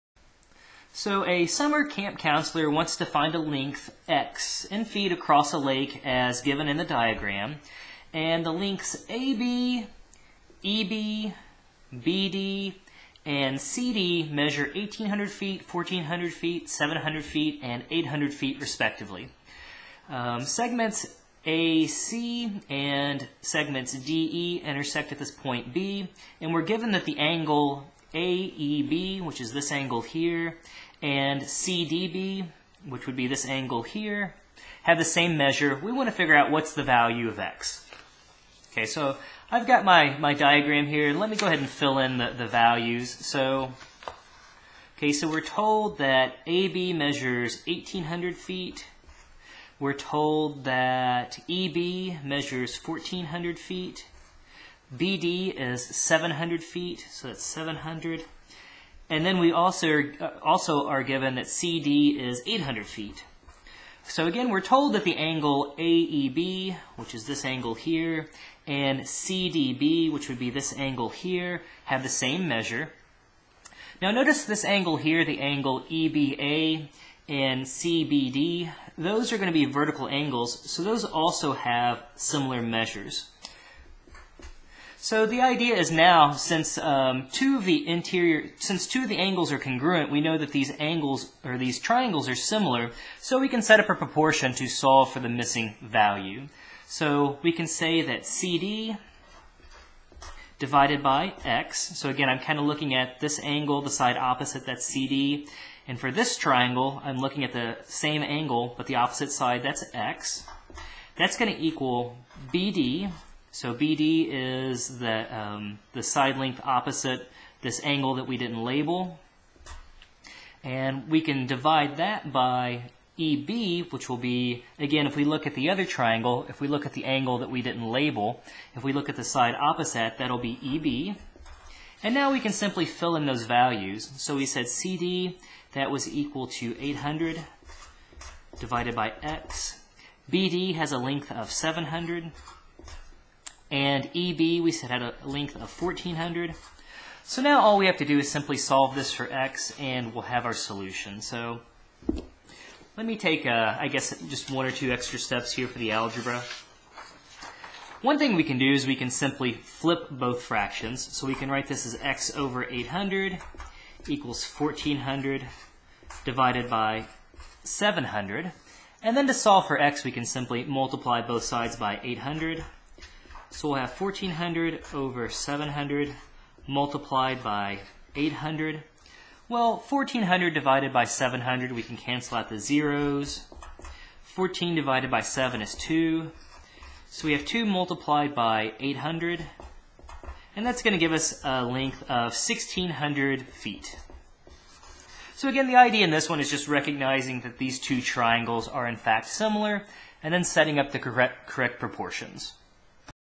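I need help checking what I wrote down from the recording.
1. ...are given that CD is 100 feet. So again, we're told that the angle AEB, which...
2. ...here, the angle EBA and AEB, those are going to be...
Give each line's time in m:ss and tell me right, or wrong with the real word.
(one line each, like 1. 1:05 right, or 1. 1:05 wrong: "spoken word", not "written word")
1. 1:00 wrong: "800", not "100"
2. 1:14 wrong: "CBD", not "AEB".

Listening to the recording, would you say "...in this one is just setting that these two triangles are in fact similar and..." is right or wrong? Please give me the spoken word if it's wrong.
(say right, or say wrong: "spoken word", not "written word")
wrong: "recognizing", not "setting".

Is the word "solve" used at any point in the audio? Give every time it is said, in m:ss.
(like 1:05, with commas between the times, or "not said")
1:34, 2:28, 2:49.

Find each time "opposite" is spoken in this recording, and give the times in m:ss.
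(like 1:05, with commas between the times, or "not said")
1:44, 1:48, 1:56, 2:09.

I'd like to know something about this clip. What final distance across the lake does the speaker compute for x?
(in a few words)
1,600 feet.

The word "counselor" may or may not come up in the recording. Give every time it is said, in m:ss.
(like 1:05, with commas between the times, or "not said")
0:02.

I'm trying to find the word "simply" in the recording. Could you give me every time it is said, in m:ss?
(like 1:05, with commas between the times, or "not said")
2:12, 2:28, 2:39, 2:50.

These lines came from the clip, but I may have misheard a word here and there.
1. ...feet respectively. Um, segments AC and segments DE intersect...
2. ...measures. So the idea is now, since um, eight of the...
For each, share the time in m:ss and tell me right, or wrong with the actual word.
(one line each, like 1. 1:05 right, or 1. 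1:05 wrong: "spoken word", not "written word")
1. 0:18 right
2. 1:22 wrong: "two", not "eight".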